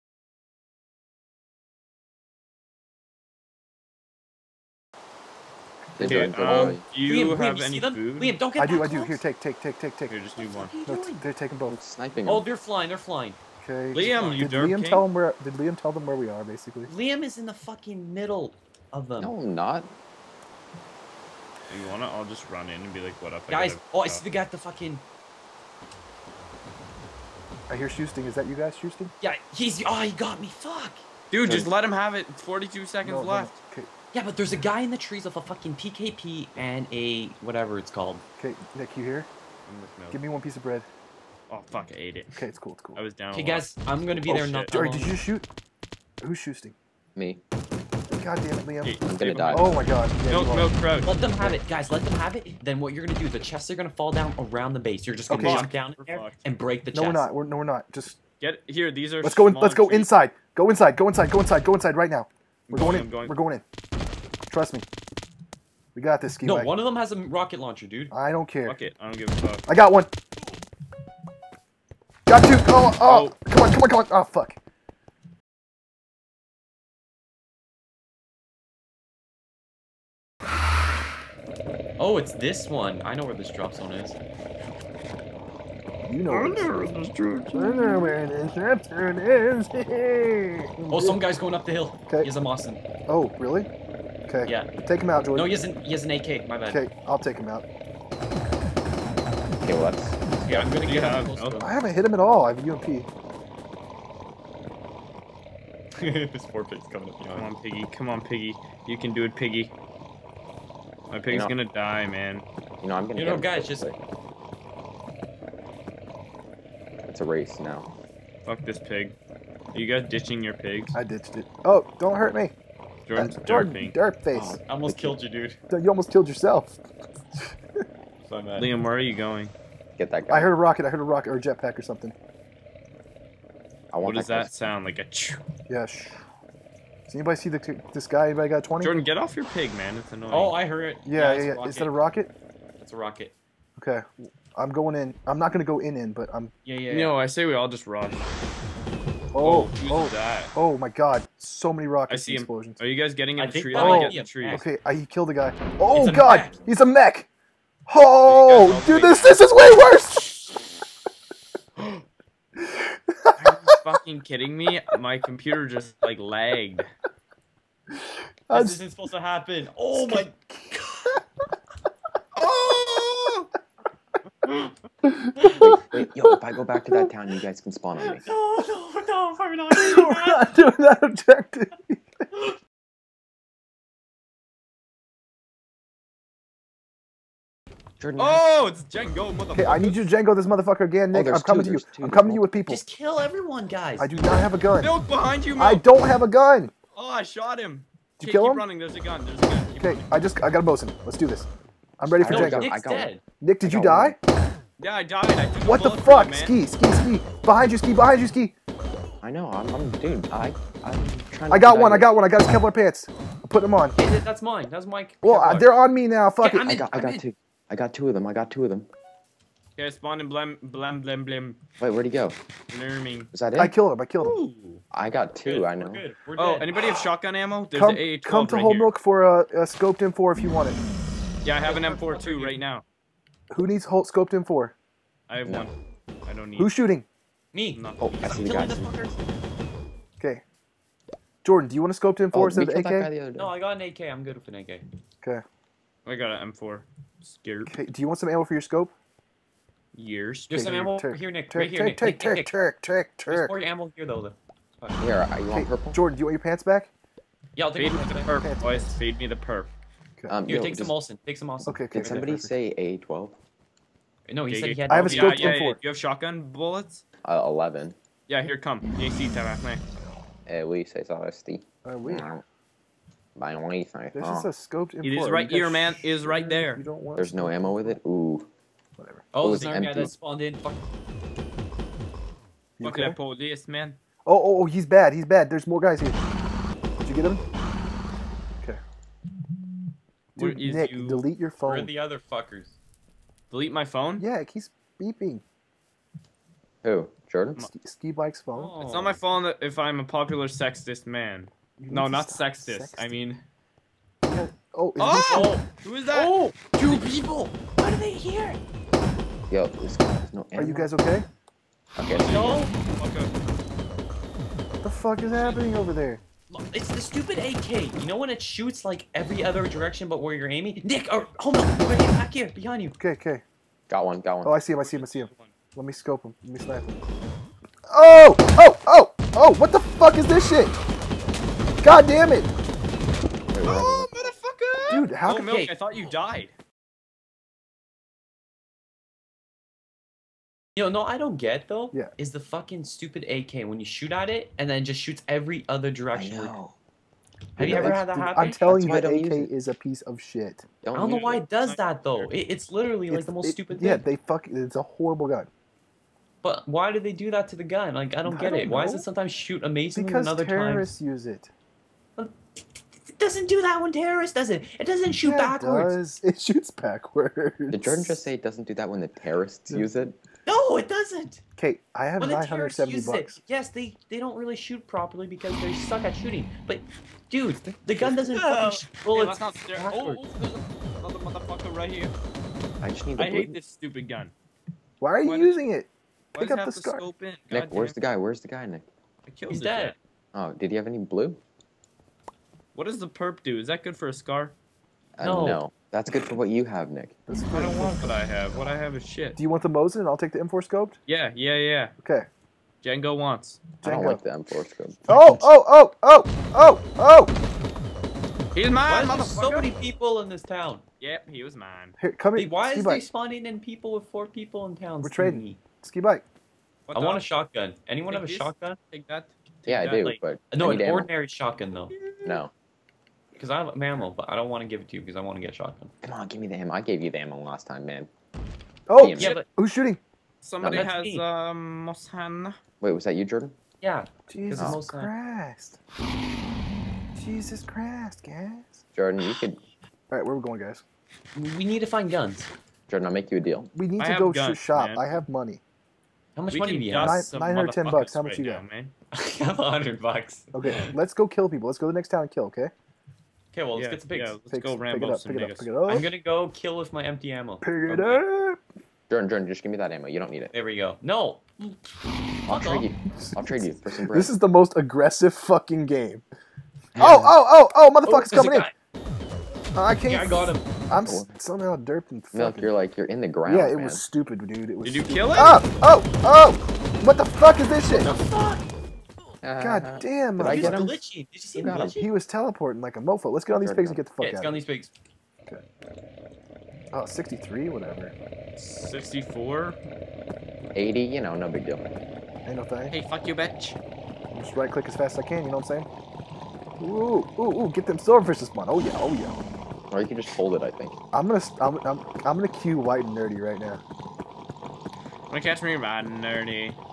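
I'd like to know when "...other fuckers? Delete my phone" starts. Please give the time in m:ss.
4:51.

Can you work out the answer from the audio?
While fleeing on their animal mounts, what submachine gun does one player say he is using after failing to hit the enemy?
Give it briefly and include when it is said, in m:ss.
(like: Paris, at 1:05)
UMP, at 1:42.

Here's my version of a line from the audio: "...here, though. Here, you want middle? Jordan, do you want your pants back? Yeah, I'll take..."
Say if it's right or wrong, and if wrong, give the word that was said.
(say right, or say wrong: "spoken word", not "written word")
wrong: "purple", not "middle".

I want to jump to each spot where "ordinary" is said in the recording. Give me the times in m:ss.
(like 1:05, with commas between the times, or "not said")
7:00.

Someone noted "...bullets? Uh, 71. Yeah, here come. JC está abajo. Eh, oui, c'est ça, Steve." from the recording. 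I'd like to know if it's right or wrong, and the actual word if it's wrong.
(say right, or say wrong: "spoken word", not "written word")
wrong: "11", not "71".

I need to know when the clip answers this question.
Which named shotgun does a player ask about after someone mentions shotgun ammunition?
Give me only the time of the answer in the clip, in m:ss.
4:22.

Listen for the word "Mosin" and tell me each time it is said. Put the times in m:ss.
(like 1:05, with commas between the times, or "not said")
1:32, 6:39.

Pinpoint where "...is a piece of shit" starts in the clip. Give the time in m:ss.
5:49.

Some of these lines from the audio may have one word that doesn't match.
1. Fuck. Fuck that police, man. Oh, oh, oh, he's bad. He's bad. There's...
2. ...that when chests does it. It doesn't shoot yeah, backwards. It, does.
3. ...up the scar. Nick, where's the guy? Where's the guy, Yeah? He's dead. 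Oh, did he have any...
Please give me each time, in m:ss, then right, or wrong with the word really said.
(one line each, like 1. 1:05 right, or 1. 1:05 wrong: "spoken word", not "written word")
1. 4:40 right
2. 6:03 wrong: "terrorists", not "chests"
3. 6:26 wrong: "Nick", not "Yeah".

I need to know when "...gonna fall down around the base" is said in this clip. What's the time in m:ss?
0:53.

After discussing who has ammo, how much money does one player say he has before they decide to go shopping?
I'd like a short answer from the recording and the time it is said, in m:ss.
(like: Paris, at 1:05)
110 bucks, at 7:27.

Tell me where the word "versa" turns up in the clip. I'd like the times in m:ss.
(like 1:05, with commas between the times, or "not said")
not said.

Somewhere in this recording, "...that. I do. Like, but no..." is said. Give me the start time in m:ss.
6:59.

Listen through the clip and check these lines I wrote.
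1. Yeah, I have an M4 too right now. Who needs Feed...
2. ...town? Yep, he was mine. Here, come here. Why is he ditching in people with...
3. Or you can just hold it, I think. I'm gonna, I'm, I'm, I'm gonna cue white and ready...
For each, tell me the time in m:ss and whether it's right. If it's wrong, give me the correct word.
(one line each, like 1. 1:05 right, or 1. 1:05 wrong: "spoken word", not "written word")
1. 3:51 wrong: "Holt", not "Feed"
2. 6:50 wrong: "spawning", not "ditching"
3. 8:19 wrong: "nerdy", not "ready".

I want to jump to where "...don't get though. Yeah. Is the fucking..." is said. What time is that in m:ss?
5:41.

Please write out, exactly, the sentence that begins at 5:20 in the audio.
Nick, or hold on, right back here, behind you.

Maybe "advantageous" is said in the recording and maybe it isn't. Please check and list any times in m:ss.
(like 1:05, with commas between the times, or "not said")
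not said.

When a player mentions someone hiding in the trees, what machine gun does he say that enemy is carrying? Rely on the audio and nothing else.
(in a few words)
PKP.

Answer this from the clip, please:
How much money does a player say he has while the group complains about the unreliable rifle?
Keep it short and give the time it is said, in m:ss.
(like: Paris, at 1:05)
970 bucks, at 6:12.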